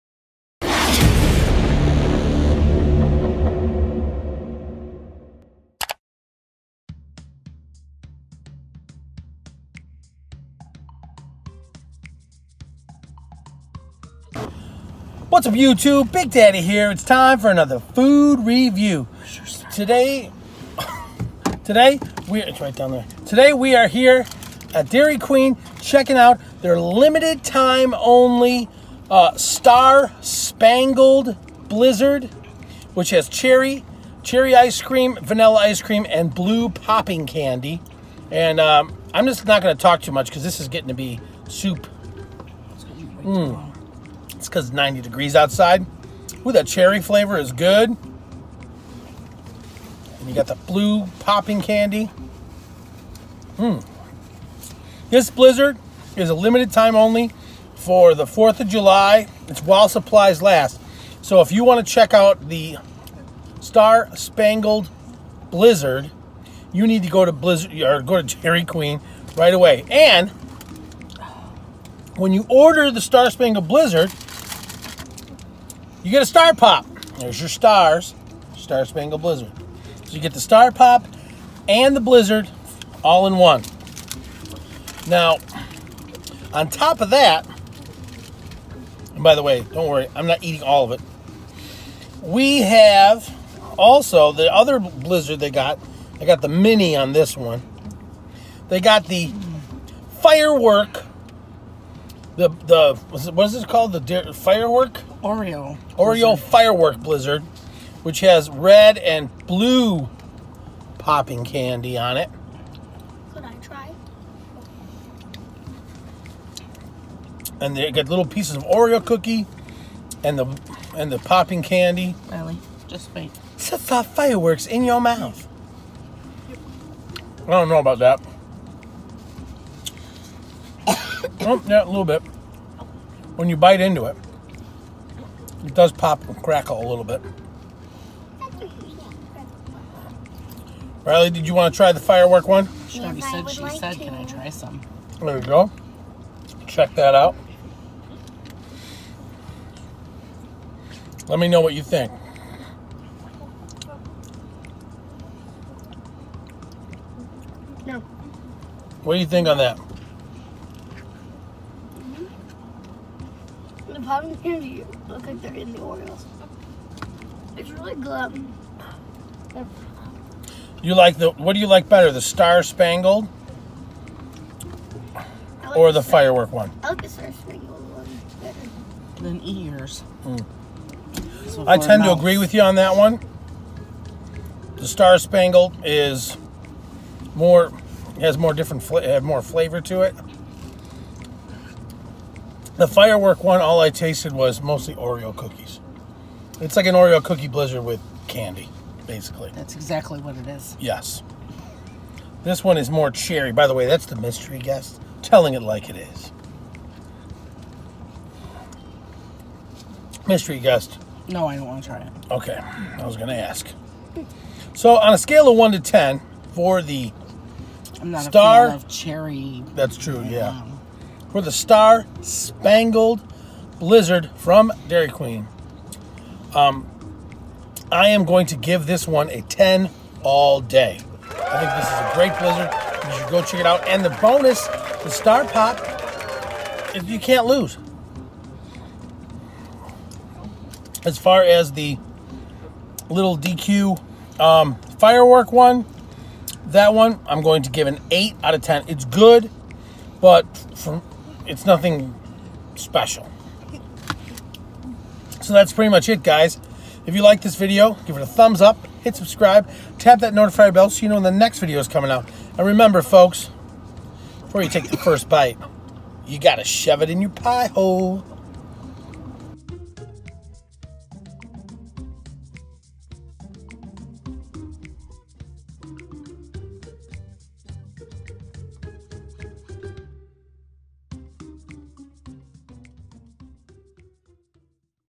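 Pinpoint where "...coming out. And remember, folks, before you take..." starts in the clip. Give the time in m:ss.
4:21.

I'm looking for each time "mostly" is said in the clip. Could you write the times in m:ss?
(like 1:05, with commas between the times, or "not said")
3:14.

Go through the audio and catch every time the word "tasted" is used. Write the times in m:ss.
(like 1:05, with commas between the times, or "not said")
3:13.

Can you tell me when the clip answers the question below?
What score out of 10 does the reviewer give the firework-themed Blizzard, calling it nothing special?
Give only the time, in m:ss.
4:08.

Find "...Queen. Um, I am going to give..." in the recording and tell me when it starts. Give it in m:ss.
3:45.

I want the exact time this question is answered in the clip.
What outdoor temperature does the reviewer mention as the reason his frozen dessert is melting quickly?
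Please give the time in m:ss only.
0:44.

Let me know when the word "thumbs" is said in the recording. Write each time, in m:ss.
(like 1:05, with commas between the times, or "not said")
4:18.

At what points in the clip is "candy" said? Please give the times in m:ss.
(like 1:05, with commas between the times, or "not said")
0:37, 0:51, 1:51, 2:01, 2:44, 3:18.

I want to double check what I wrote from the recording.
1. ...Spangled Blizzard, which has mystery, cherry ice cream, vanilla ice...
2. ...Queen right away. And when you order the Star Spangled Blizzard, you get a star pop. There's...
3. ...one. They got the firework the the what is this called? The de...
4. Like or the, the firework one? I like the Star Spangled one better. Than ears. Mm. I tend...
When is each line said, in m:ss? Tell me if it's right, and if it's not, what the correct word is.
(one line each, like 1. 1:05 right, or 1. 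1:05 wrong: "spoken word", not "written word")
1. 0:30 wrong: "cherry", not "mystery"
2. 1:08 right
3. 1:37 right
4. 2:55 right.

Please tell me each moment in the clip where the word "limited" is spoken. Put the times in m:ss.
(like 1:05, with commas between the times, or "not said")
0:26, 0:56.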